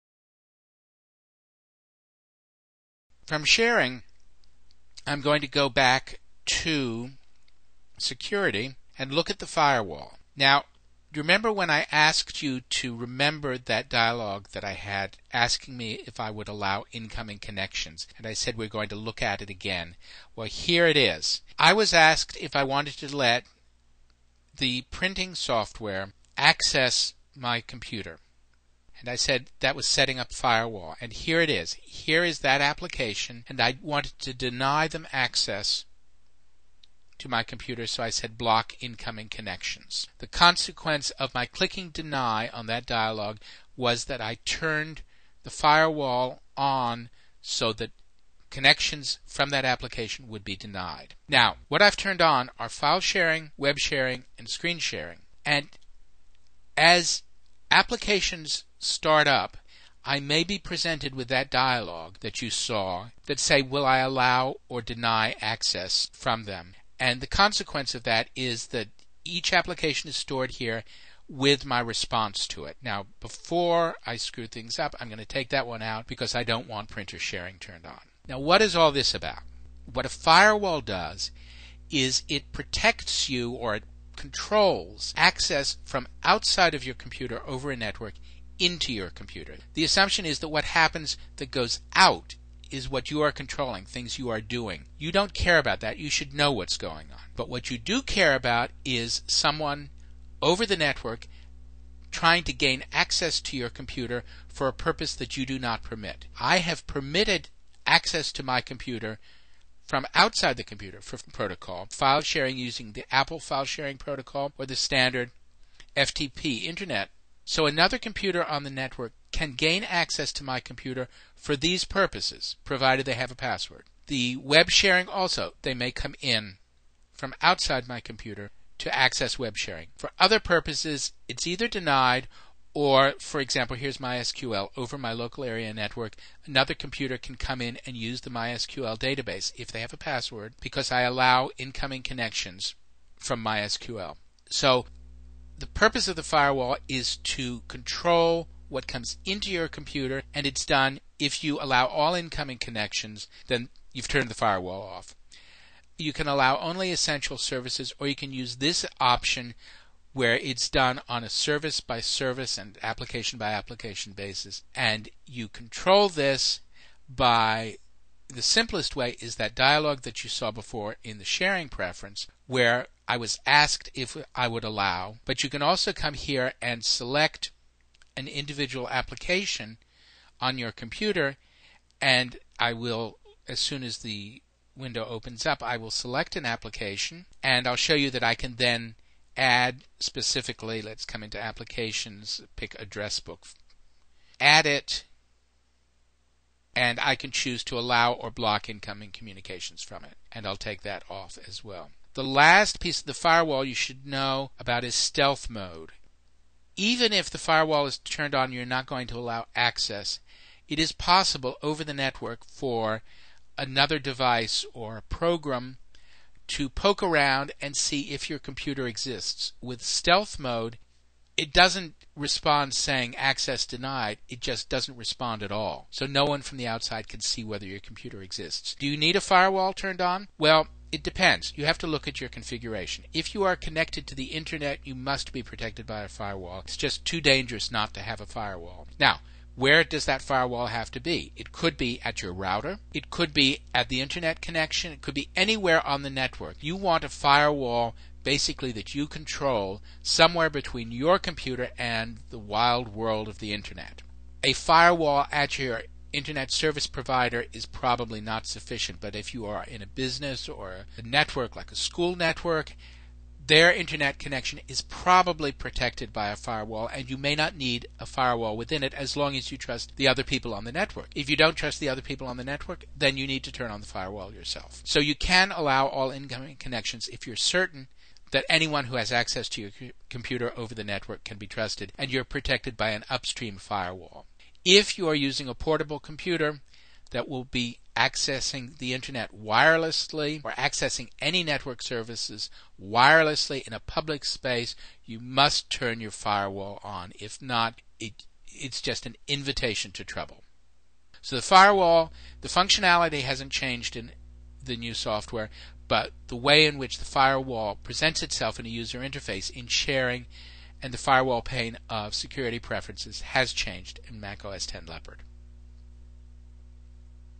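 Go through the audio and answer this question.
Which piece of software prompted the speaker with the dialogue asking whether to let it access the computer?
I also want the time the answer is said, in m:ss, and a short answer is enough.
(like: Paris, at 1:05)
printing software, at 0:24.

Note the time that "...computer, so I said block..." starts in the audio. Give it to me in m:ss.
0:37.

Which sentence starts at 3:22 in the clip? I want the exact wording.
The last piece of the firewall you should know about is stealth mode.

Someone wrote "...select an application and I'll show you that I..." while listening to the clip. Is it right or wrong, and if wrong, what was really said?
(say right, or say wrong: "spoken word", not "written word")
right.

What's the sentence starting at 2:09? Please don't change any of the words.
For other purposes, it's either denied or, for example, here's MySQL over my local area network.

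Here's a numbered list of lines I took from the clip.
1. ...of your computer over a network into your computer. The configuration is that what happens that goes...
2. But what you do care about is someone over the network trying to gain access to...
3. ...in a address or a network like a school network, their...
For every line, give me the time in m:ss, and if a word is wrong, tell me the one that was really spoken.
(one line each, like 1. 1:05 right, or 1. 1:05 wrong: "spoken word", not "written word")
1. 1:26 wrong: "assumption", not "configuration"
2. 1:37 right
3. 4:19 wrong: "business", not "address".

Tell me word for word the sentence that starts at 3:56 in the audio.
It's just too dangerous not to have a firewall.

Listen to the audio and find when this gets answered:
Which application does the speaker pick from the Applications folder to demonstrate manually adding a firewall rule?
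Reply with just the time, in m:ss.
3:12.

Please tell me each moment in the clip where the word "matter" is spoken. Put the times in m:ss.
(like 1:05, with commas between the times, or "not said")
not said.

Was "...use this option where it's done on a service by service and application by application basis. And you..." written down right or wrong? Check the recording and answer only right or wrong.
right.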